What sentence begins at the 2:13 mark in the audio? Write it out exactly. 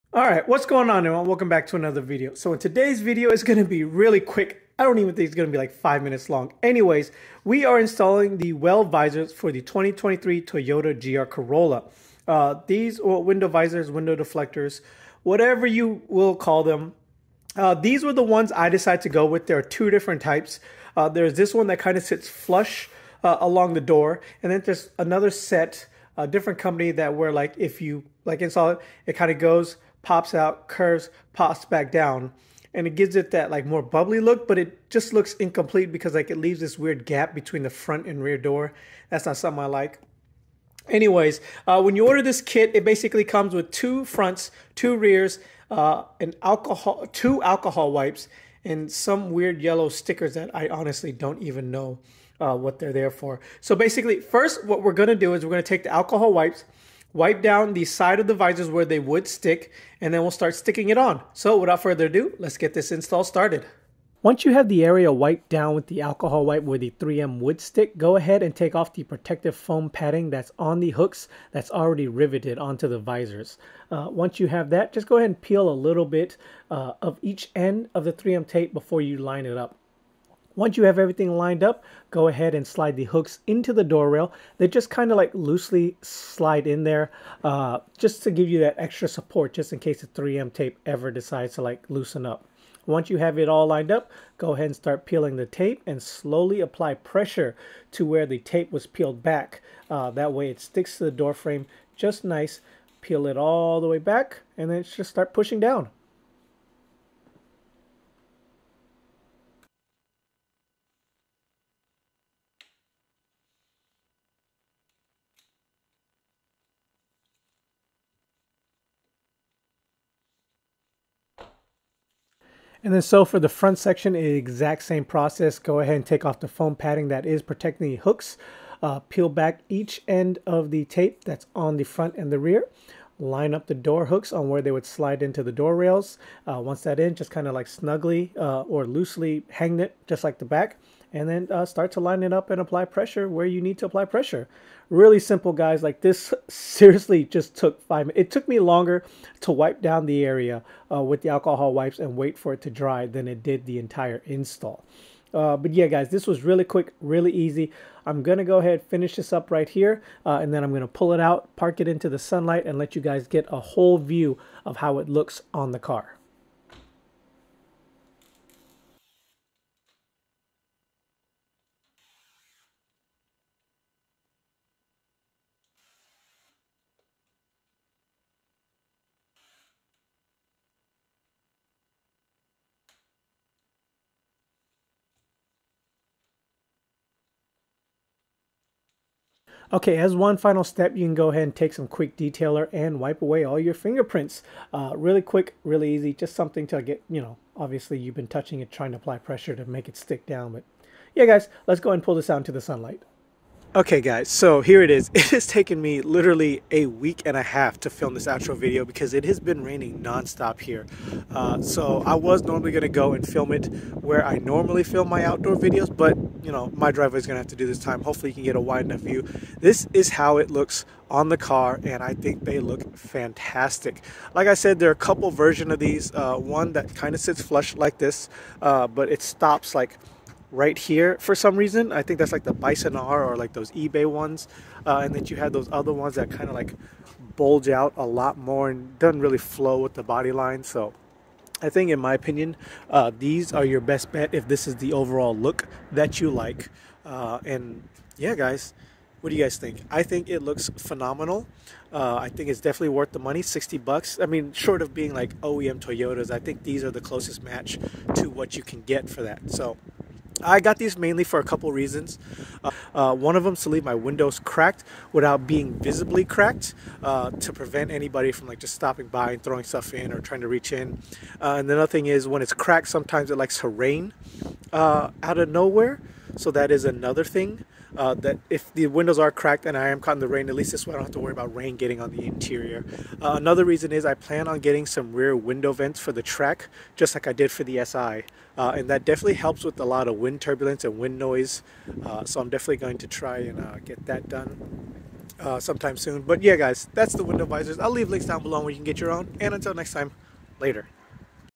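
Line up the door hooks on where they would slide into the door rails.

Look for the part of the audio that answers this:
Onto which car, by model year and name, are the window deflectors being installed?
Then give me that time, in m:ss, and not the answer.
0:09.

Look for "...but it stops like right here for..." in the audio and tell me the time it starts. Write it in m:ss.
3:48.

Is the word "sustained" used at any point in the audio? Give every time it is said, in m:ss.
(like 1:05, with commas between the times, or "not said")
not said.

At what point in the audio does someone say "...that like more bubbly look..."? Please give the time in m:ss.
0:33.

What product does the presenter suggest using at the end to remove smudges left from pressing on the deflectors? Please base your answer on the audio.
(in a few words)
Quick detailer.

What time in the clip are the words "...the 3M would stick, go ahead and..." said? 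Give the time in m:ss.
1:06.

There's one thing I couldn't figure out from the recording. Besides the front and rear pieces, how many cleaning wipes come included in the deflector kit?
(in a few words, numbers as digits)
2.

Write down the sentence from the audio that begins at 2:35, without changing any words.
Uh, but yeah, guys, this was really quick, really easy.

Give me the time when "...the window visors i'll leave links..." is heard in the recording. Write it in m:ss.
4:57.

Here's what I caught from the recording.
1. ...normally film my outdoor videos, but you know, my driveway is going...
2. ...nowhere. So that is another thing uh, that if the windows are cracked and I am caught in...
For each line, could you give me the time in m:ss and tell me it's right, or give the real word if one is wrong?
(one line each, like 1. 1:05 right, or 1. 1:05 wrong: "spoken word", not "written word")
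1. 3:34 right
2. 4:35 right.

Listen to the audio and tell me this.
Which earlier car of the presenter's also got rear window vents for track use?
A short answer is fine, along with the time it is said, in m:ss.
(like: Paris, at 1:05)
The SI, at 4:47.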